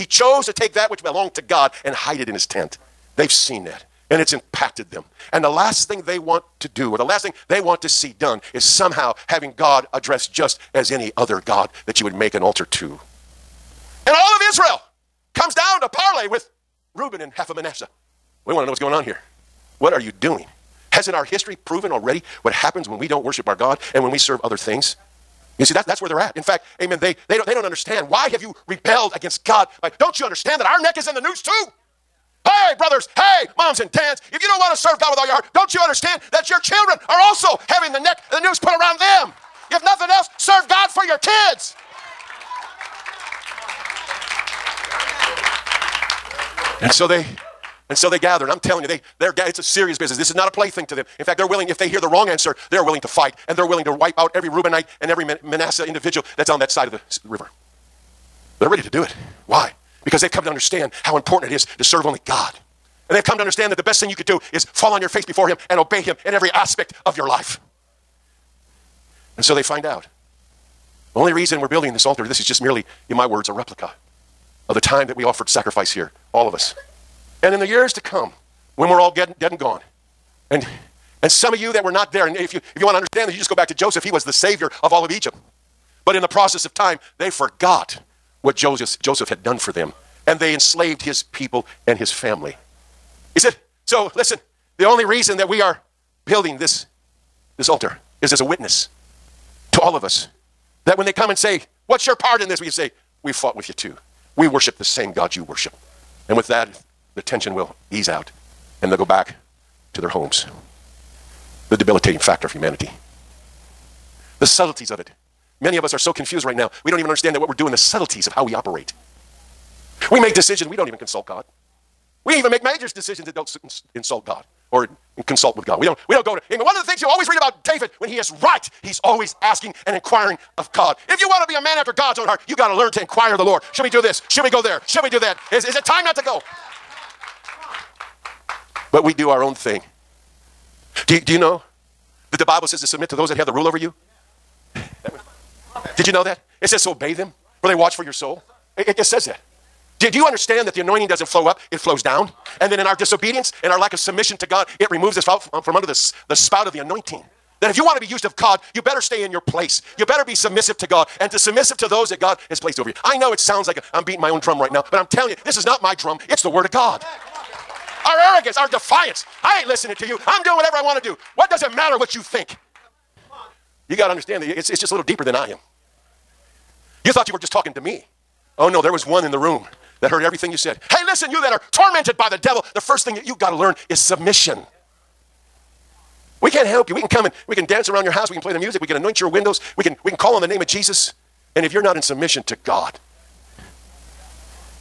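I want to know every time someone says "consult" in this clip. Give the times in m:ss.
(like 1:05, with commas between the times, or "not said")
2:00, 2:05.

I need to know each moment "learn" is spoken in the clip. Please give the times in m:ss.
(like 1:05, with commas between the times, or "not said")
2:12, 3:03.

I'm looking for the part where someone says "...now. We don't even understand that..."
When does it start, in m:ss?
1:56.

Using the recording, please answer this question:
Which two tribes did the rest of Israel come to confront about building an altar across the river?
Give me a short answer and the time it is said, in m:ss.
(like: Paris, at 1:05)
Reuben and half of Manasseh, at 0:16.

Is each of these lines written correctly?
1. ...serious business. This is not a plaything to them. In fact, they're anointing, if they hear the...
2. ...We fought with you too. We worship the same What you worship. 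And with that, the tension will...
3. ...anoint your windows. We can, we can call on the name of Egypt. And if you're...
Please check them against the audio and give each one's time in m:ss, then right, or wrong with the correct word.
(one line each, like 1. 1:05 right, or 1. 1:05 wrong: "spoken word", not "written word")
1. 0:49 wrong: "willing", not "anointing"
2. 1:43 wrong: "God", not "What"
3. 3:08 wrong: "Jesus", not "Egypt".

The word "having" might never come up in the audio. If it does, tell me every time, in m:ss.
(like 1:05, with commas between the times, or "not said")
0:09, 0:37.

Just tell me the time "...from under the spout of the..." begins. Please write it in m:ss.
2:35.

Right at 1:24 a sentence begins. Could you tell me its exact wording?
He was the savior of all of Egypt.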